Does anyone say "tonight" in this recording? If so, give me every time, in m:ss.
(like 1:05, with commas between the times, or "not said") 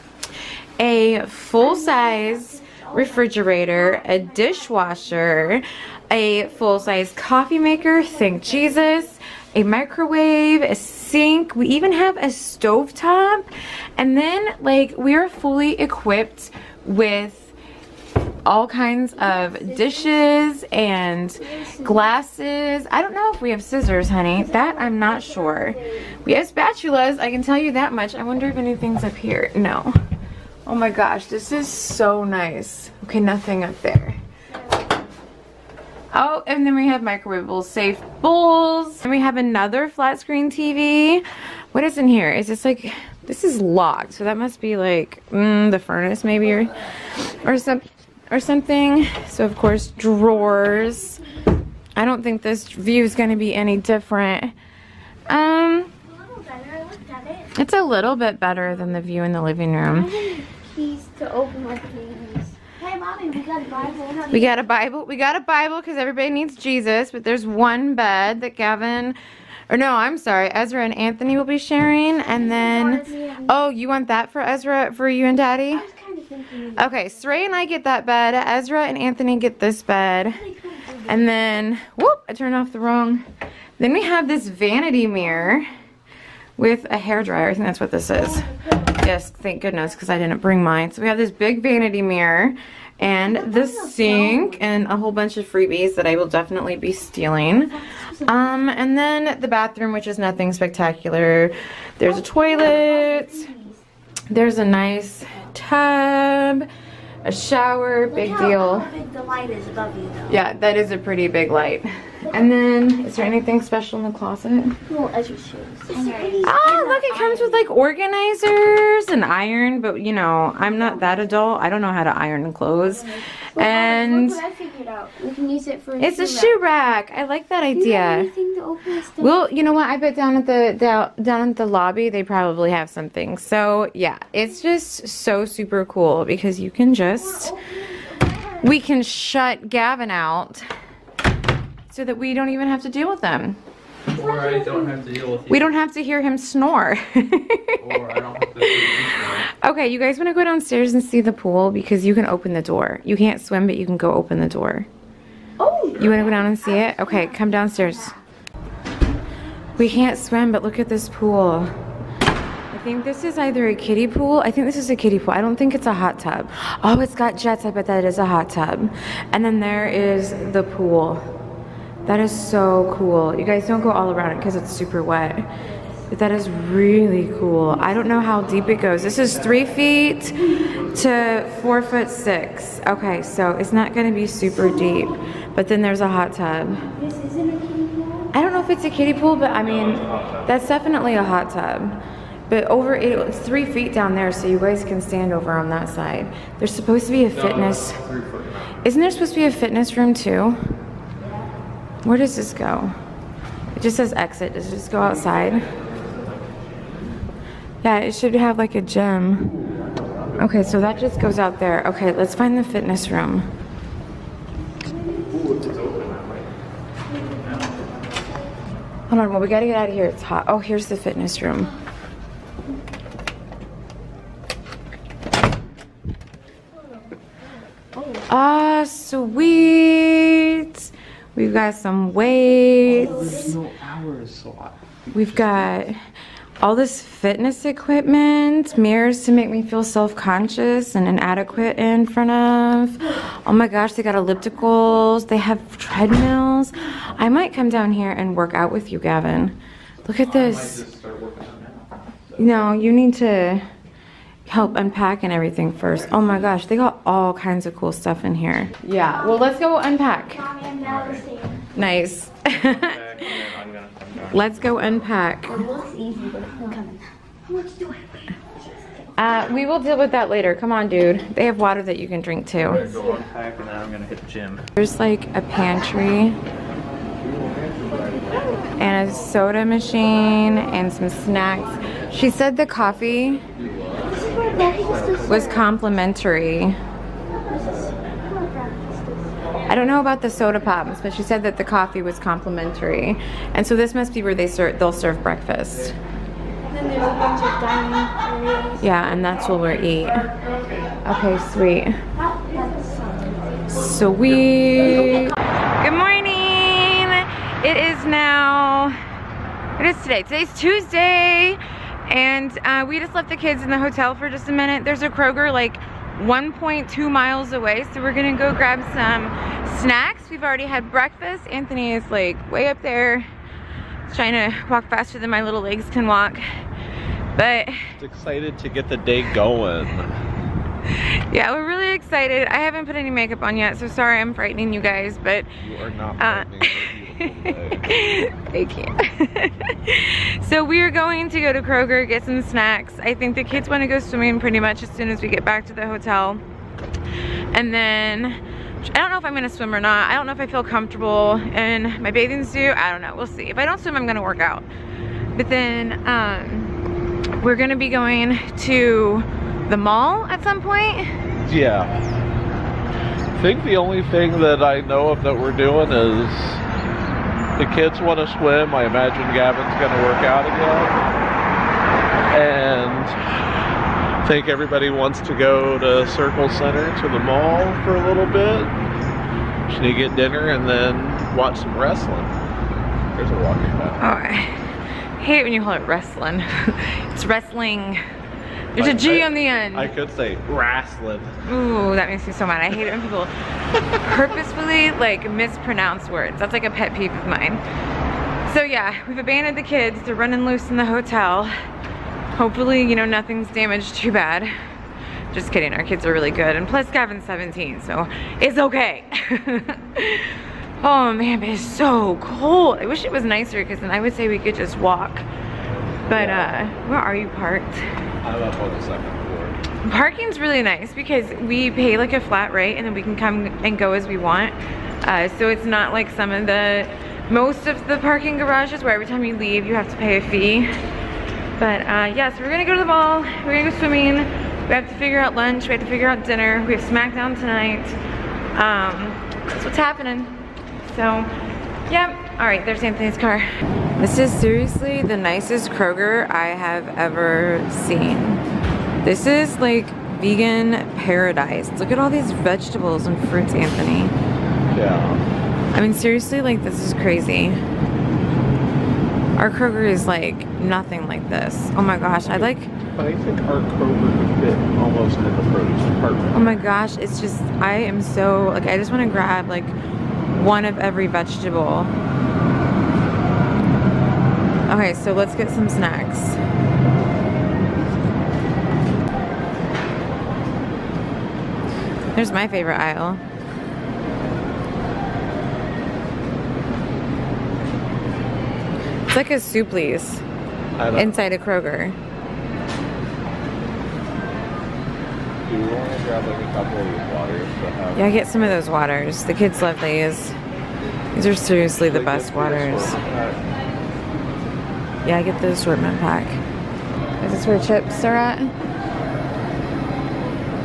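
7:17.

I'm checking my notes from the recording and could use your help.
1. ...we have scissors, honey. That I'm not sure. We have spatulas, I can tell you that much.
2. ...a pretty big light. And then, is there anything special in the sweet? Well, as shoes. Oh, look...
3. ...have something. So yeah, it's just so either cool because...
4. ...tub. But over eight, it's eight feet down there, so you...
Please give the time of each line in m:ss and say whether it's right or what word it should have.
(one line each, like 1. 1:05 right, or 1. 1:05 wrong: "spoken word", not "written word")
1. 0:23 right
2. 1:50 wrong: "closet", not "sweet"
3. 2:12 wrong: "super", not "either"
4. 3:11 wrong: "three", not "eight".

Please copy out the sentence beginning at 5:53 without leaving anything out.
If I don't swim, I'm gonna work out.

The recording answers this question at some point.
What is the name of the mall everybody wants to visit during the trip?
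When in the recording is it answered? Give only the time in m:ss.
6:16.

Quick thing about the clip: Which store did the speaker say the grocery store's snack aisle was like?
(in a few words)
Suplees.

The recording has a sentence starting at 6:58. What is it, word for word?
I love all the second floor.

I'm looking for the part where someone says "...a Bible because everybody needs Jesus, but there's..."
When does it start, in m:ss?
1:05.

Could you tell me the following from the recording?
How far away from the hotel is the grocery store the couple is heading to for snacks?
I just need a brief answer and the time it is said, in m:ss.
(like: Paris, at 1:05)
1.2 miles, at 5:16.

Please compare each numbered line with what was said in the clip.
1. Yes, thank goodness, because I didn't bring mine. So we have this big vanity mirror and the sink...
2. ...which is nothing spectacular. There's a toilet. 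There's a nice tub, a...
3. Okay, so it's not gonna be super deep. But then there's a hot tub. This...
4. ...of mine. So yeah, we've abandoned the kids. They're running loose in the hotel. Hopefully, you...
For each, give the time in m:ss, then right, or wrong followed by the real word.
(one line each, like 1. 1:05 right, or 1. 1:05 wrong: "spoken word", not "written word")
1. 1:29 right
2. 1:39 right
3. 3:02 right
4. 6:37 right.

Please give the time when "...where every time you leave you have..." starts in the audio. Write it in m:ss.
7:08.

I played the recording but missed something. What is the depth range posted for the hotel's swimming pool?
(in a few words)
3 feet to 4 foot 6.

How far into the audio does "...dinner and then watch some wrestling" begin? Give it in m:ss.
6:20.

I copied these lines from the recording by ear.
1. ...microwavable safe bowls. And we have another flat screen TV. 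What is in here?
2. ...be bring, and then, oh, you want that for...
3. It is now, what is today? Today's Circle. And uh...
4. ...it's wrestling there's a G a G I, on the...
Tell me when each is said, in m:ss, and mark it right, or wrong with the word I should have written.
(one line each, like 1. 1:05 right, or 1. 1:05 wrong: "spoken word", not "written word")
1. 0:37 right
2. 1:11 wrong: "sharing", not "bring"
3. 5:07 wrong: "Tuesday", not "Circle"
4. 6:27 right.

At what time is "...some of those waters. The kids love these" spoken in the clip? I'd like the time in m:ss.
8:18.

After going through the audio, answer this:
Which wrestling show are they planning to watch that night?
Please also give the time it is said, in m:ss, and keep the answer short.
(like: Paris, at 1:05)
SmackDown, at 7:16.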